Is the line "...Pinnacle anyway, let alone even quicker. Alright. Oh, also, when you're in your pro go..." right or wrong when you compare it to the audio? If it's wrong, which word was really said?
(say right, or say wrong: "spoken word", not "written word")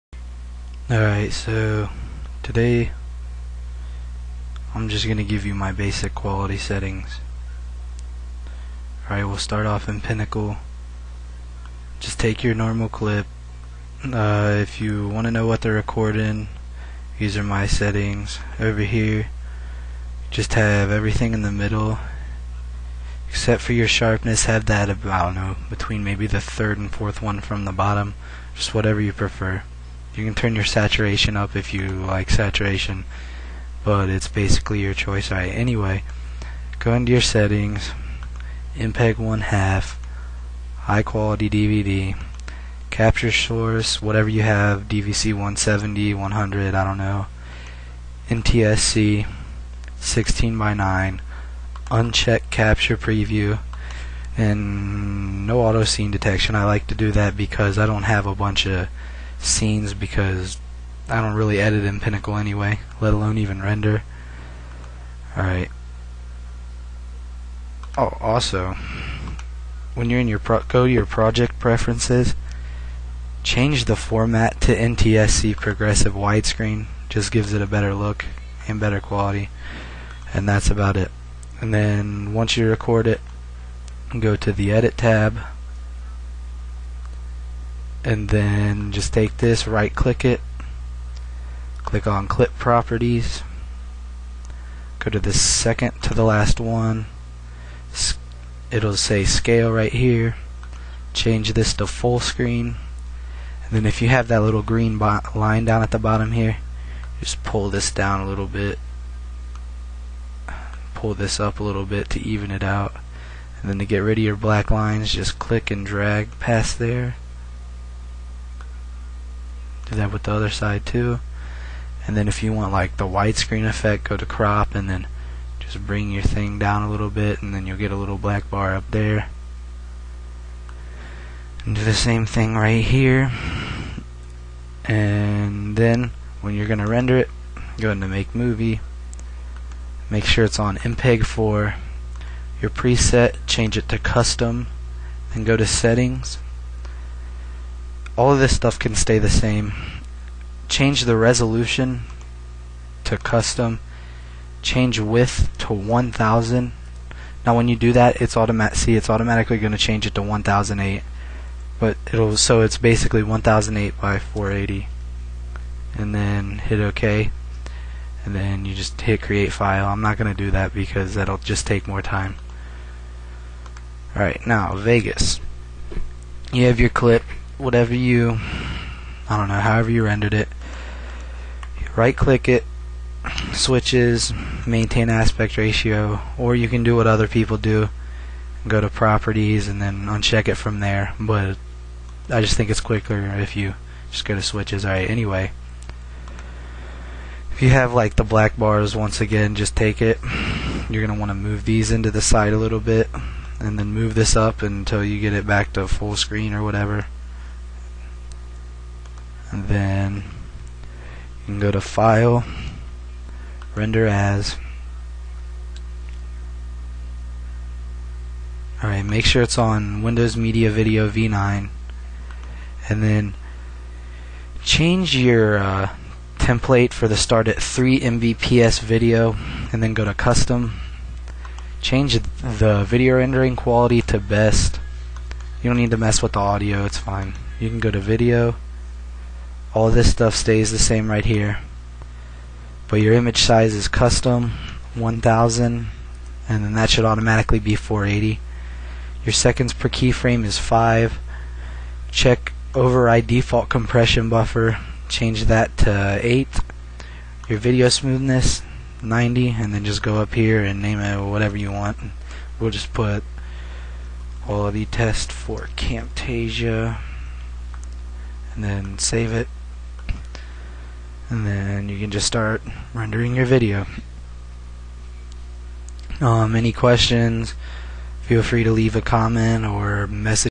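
wrong: "render", not "quicker".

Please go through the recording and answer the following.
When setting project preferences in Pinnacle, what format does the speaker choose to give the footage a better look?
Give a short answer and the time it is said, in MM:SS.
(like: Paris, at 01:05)
NTSC progressive widescreen, at 01:14.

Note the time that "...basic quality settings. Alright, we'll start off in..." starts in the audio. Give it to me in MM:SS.
00:05.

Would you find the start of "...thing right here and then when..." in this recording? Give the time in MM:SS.
02:12.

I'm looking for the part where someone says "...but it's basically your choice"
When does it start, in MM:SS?
00:33.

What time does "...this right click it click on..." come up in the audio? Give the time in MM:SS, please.
01:29.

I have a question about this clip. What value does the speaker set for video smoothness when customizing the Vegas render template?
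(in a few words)
90.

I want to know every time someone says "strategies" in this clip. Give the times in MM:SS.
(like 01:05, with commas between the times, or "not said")
not said.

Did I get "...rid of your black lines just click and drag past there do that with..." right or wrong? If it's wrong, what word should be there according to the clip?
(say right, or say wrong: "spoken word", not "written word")
right.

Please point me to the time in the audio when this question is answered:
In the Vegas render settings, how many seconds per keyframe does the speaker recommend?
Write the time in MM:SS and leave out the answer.
04:10.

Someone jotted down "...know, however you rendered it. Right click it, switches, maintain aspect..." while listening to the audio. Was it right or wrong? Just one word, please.
right.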